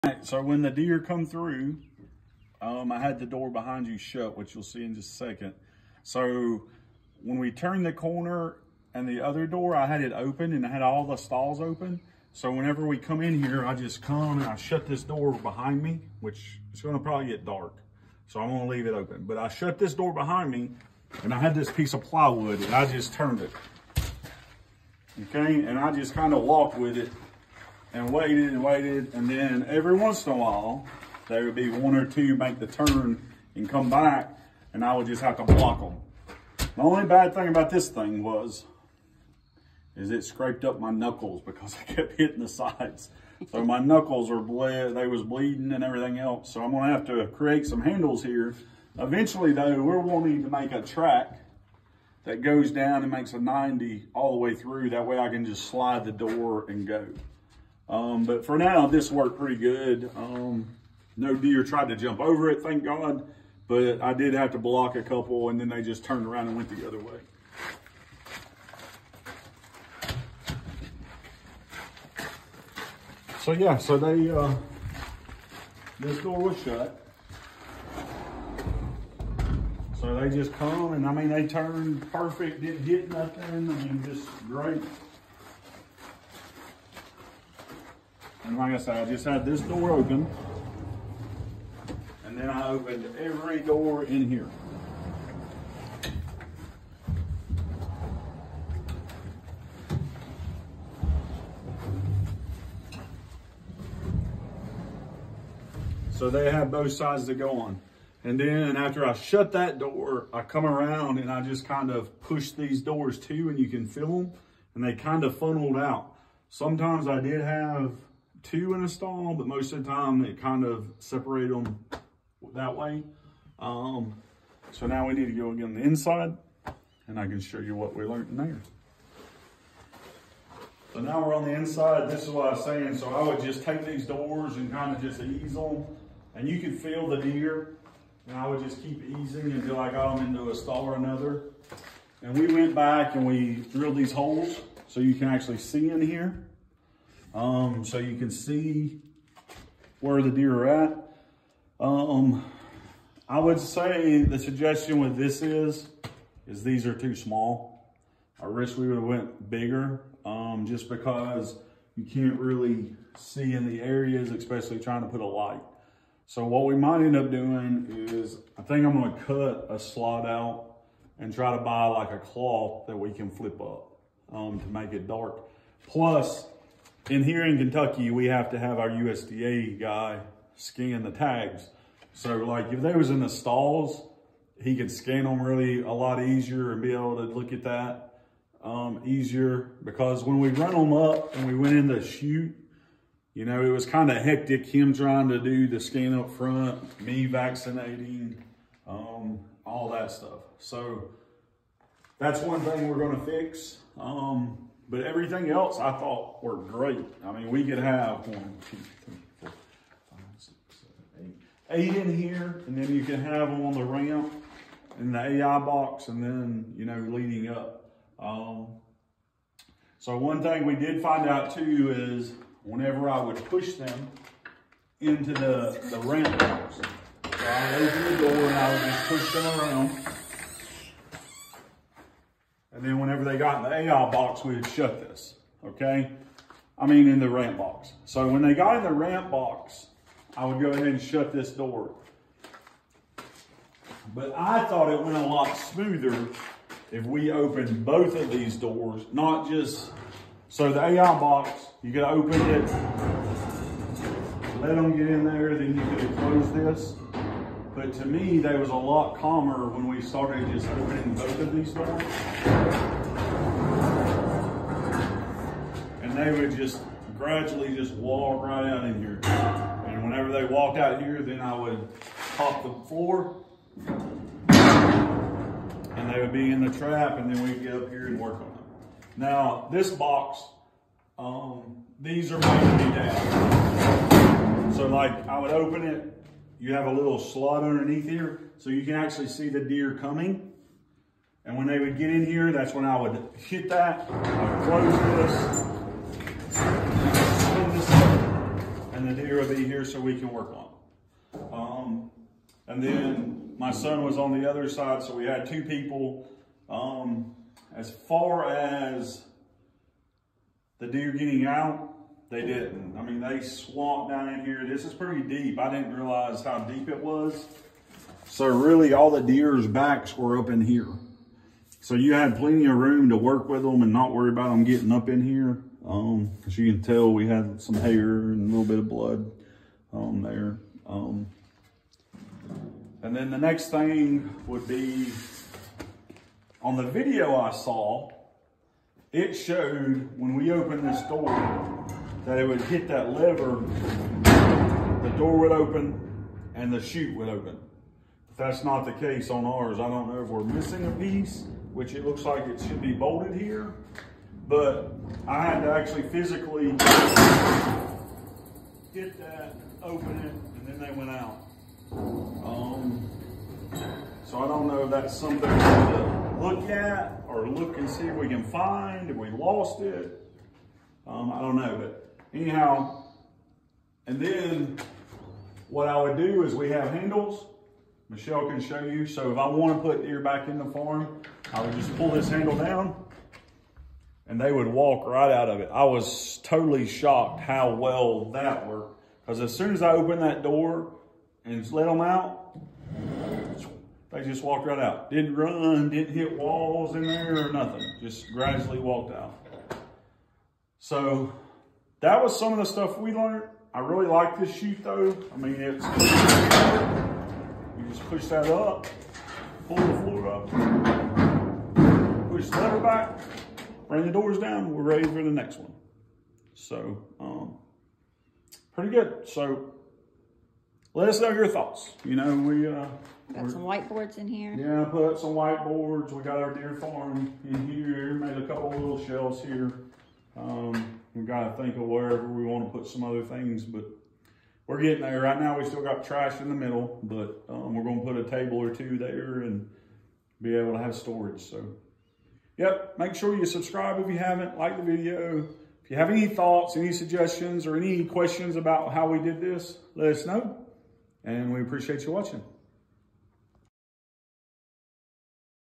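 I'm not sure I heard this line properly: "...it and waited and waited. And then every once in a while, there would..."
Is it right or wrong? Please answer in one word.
right.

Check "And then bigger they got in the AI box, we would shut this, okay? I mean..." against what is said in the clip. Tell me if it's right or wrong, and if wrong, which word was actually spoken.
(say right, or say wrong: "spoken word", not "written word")
wrong: "whenever", not "bigger".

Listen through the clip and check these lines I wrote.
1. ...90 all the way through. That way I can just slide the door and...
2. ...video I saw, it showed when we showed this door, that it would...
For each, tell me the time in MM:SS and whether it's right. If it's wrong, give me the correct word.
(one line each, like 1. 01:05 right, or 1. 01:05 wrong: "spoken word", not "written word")
1. 00:53 right
2. 05:36 wrong: "opened", not "showed".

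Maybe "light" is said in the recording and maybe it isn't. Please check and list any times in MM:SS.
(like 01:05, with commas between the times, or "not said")
02:45.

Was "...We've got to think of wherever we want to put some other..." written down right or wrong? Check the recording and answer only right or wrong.
right.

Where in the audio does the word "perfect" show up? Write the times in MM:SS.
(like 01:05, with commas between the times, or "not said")
01:22.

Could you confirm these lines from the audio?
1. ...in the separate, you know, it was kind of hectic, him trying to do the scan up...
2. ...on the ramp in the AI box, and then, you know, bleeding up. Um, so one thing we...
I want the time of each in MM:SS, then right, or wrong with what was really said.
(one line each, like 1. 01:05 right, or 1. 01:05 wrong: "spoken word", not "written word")
1. 03:11 wrong: "chute", not "separate"
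2. 03:33 wrong: "leading", not "bleeding".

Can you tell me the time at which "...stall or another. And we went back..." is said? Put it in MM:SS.
02:20.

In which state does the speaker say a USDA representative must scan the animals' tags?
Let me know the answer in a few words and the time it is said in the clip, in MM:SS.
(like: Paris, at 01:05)
Kentucky, at 02:57.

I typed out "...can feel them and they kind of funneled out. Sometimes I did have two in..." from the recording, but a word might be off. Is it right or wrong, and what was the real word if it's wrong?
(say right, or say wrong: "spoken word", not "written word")
right.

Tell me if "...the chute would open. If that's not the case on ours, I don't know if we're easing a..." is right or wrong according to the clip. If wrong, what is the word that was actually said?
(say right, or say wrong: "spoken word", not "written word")
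wrong: "missing", not "easing".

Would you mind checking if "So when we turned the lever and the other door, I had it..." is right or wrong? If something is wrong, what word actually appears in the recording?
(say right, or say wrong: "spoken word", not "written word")
wrong: "corner", not "lever".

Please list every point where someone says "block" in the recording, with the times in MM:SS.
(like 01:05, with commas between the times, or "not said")
00:35, 01:04.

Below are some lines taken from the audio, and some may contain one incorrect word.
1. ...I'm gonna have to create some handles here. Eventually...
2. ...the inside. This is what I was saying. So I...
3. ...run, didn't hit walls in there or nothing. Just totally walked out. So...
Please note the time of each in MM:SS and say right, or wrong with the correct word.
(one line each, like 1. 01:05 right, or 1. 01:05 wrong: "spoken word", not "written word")
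1. 00:46 right
2. 02:11 right
3. 06:35 wrong: "gradually", not "totally".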